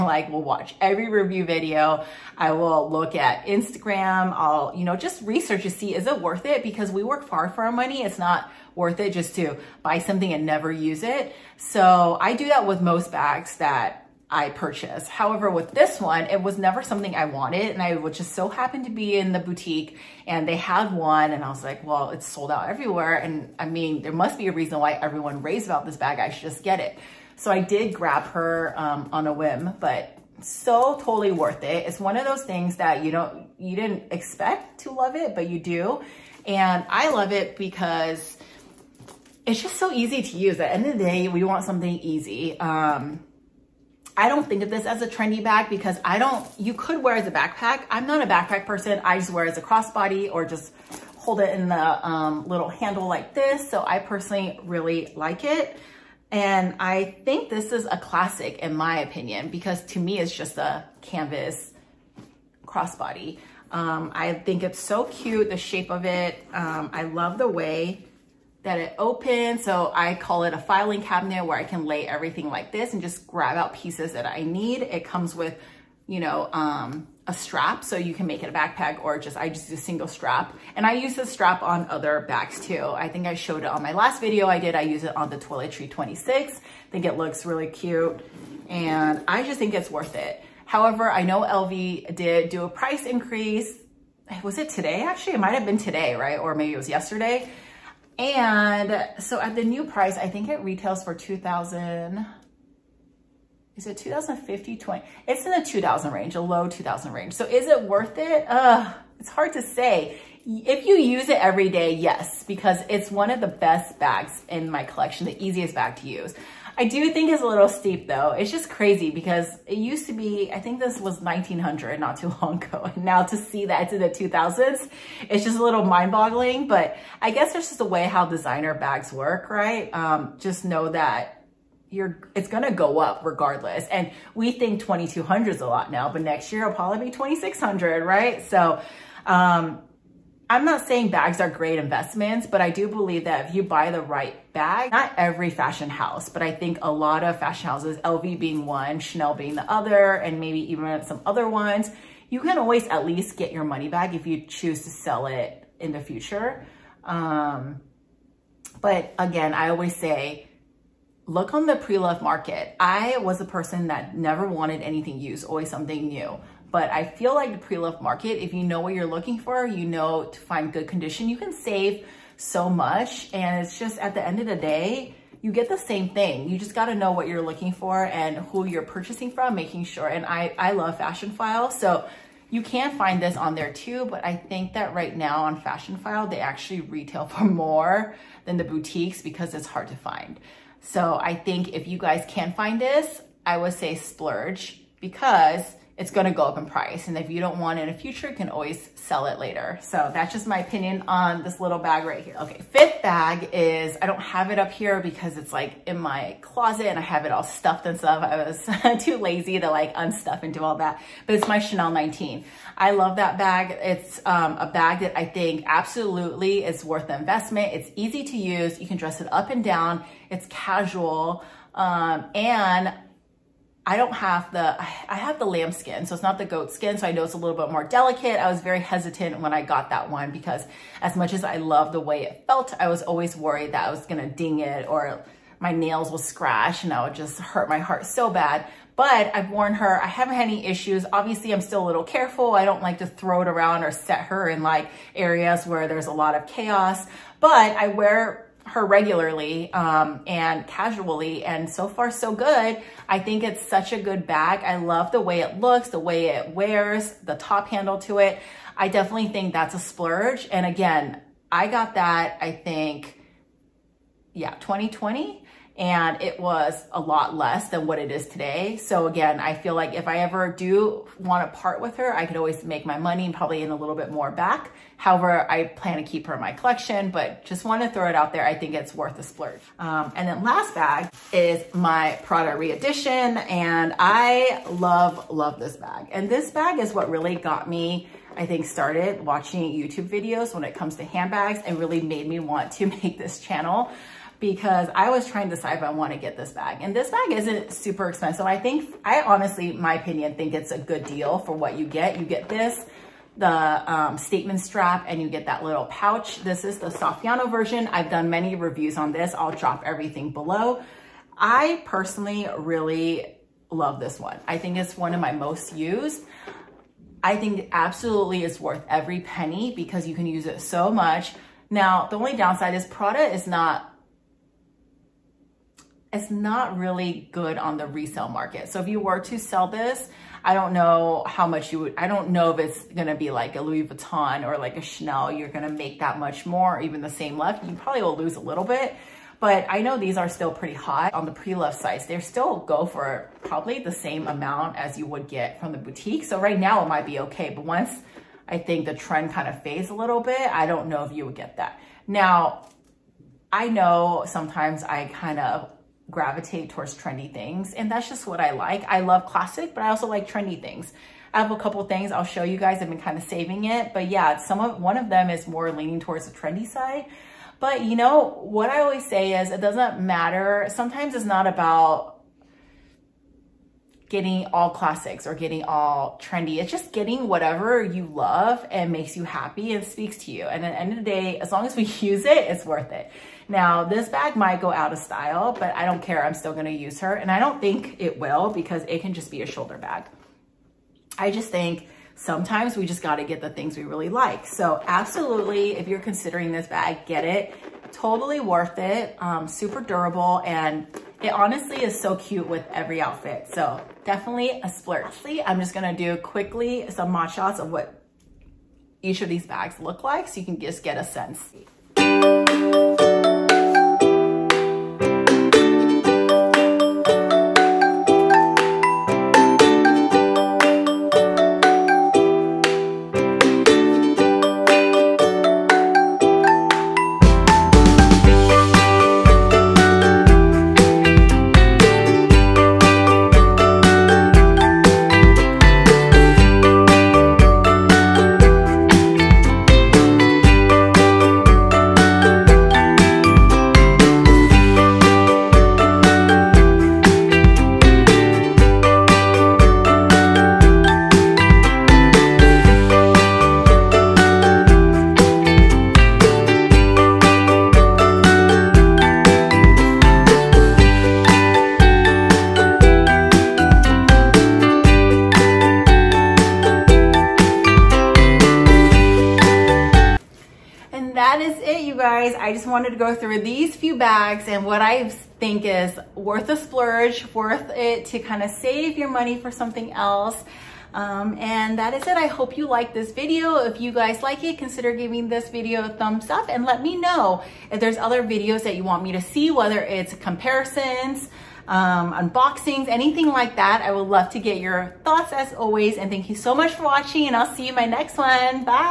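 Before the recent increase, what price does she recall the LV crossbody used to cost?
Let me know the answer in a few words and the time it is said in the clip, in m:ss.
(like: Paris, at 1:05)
1900, at 2:01.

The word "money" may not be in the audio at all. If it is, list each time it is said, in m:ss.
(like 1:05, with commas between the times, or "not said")
0:07, 2:33, 4:32, 7:59.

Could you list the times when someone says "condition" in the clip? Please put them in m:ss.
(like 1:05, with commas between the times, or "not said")
2:50.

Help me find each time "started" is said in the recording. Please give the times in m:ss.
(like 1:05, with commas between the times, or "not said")
4:48.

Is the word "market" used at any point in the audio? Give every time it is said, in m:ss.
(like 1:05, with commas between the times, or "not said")
2:42, 2:47, 5:28.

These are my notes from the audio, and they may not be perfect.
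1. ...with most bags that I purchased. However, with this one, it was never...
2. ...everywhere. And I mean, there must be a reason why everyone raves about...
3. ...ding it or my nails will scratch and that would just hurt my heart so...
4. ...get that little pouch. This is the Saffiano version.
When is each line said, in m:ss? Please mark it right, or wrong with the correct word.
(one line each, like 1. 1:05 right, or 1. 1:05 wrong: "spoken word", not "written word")
1. 0:12 right
2. 0:22 right
3. 3:54 right
4. 5:05 right.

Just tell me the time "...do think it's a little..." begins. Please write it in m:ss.
1:56.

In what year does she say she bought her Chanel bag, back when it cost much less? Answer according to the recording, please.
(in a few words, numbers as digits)
2020.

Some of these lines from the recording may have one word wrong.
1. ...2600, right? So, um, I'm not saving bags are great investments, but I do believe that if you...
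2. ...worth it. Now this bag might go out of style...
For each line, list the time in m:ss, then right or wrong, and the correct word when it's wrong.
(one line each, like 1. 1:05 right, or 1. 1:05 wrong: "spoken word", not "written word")
1. 2:17 wrong: "saying", not "saving"
2. 6:22 right.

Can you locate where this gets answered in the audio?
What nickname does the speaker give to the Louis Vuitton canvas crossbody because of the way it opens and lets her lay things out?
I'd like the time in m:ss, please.
1:10.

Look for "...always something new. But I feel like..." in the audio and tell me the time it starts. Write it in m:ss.
2:45.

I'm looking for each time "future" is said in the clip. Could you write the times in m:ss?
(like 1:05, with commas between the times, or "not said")
2:35, 3:17.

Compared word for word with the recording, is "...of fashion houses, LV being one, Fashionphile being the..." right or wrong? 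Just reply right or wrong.
wrong.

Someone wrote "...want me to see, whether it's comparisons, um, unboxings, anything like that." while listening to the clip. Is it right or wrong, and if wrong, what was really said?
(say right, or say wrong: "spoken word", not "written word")
right.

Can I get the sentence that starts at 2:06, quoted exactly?
But I guess there's just a way how designer bags work, right?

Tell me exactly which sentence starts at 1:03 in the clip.
Um, I think it's so cute, the shape of it.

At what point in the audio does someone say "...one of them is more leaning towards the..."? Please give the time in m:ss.
6:04.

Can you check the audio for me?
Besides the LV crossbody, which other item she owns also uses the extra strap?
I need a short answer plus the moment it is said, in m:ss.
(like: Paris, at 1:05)
toiletry 26, at 1:25.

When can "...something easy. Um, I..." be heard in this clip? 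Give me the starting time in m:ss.
0:41.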